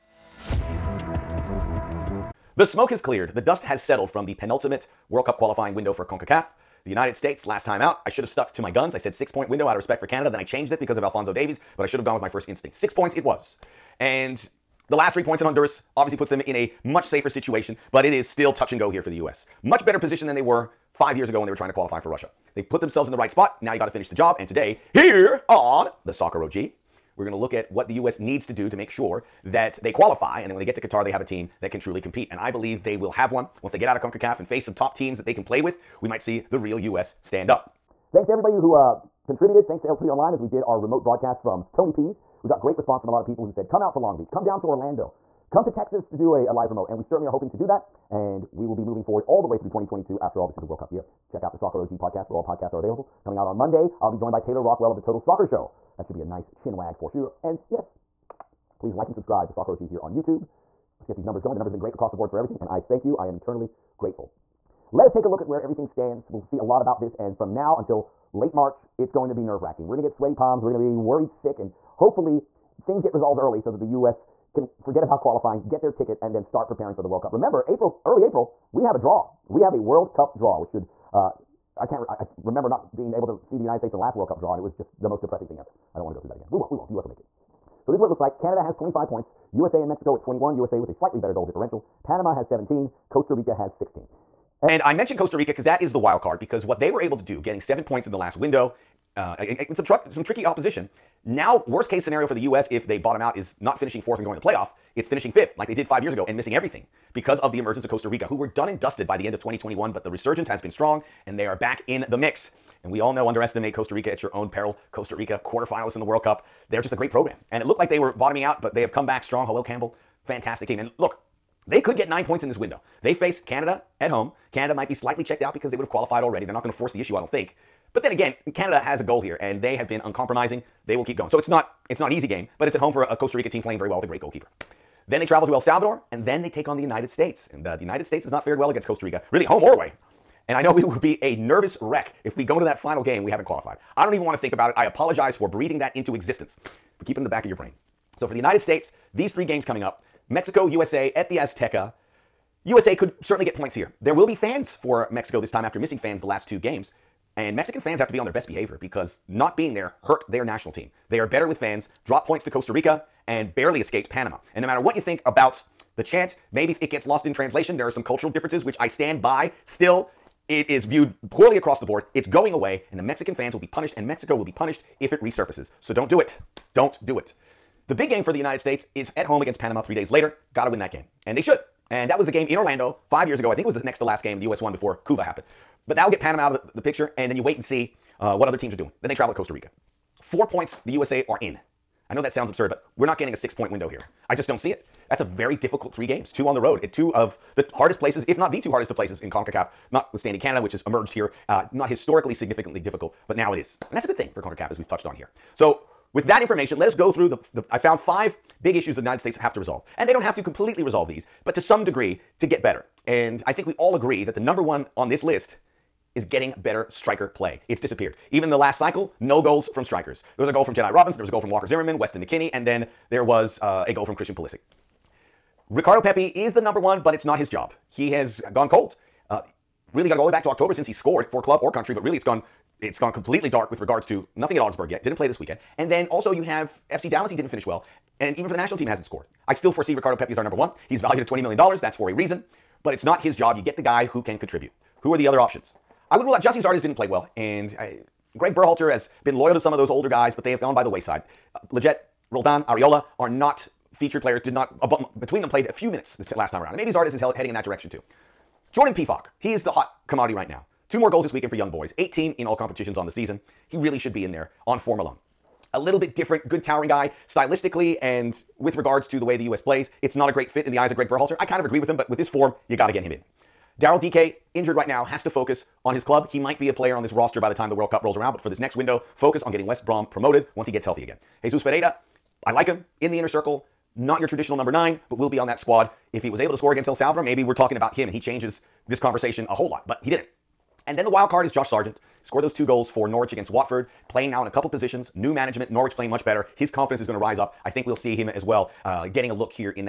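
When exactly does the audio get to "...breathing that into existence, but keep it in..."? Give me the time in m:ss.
2:25.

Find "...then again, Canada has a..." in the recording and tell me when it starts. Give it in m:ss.
2:08.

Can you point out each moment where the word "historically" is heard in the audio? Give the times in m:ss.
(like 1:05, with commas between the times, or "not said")
3:21.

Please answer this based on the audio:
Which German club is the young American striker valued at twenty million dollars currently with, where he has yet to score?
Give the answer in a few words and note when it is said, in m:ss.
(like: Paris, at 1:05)
Augsburg, at 3:54.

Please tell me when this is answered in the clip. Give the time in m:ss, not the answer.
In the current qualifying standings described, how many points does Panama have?
1:32.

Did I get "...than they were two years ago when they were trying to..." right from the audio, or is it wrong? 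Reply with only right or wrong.
wrong.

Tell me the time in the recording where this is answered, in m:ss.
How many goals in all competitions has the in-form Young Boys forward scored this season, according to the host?
4:21.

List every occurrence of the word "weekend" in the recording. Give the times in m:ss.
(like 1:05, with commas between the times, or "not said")
3:55, 4:21.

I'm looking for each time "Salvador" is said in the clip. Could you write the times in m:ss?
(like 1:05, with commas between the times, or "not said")
2:15, 4:46.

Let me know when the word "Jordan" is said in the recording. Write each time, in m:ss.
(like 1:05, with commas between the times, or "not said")
4:18.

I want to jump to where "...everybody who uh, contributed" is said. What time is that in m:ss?
0:38.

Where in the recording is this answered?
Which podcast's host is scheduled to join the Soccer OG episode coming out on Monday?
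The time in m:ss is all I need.
0:55.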